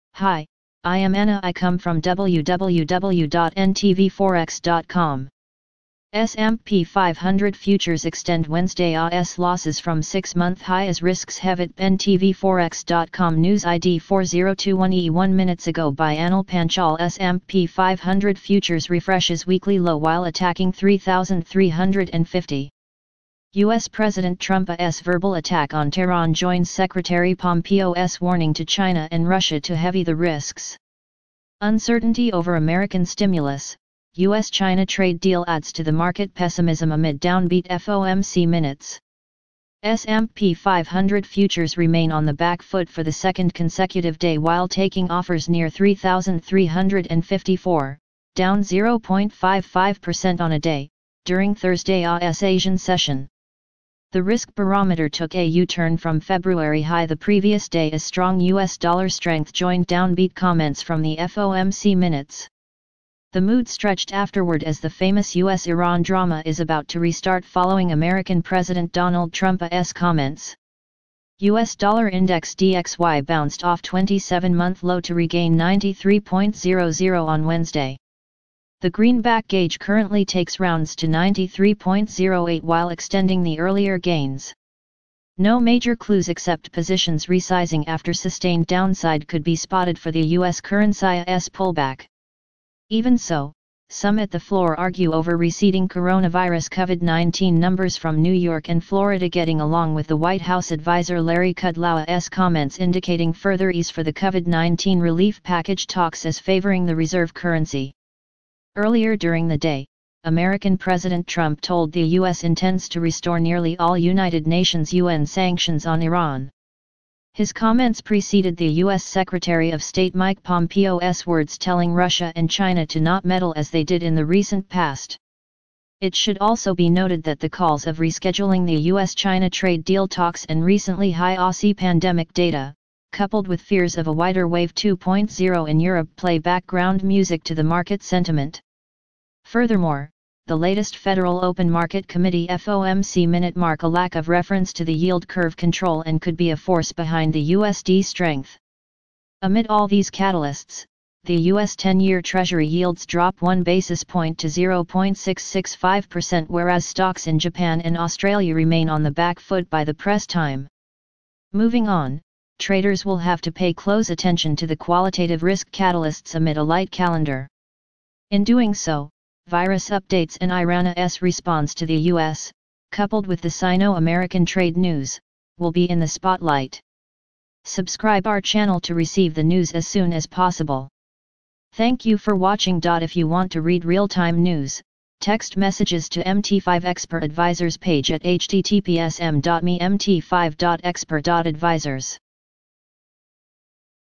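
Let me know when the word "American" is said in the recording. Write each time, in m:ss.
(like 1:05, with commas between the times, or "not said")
0:32, 1:07, 1:50, 2:53.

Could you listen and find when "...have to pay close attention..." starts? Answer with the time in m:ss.
2:43.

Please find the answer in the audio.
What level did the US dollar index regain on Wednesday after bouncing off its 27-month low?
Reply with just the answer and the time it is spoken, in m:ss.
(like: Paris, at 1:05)
93.00, at 1:15.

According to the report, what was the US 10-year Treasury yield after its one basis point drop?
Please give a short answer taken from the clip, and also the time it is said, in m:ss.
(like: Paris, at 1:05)
0.665%, at 2:34.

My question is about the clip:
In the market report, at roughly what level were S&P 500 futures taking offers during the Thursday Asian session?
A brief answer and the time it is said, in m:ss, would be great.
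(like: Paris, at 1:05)
3,354, at 0:45.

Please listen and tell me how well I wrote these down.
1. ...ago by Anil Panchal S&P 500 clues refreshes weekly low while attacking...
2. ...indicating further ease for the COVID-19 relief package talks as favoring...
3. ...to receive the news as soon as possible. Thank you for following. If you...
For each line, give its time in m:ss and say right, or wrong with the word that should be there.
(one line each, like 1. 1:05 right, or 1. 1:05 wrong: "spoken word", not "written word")
1. 0:15 wrong: "futures", not "clues"
2. 1:42 right
3. 2:58 wrong: "watching", not "following".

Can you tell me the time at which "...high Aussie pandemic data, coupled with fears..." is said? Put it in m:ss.
2:11.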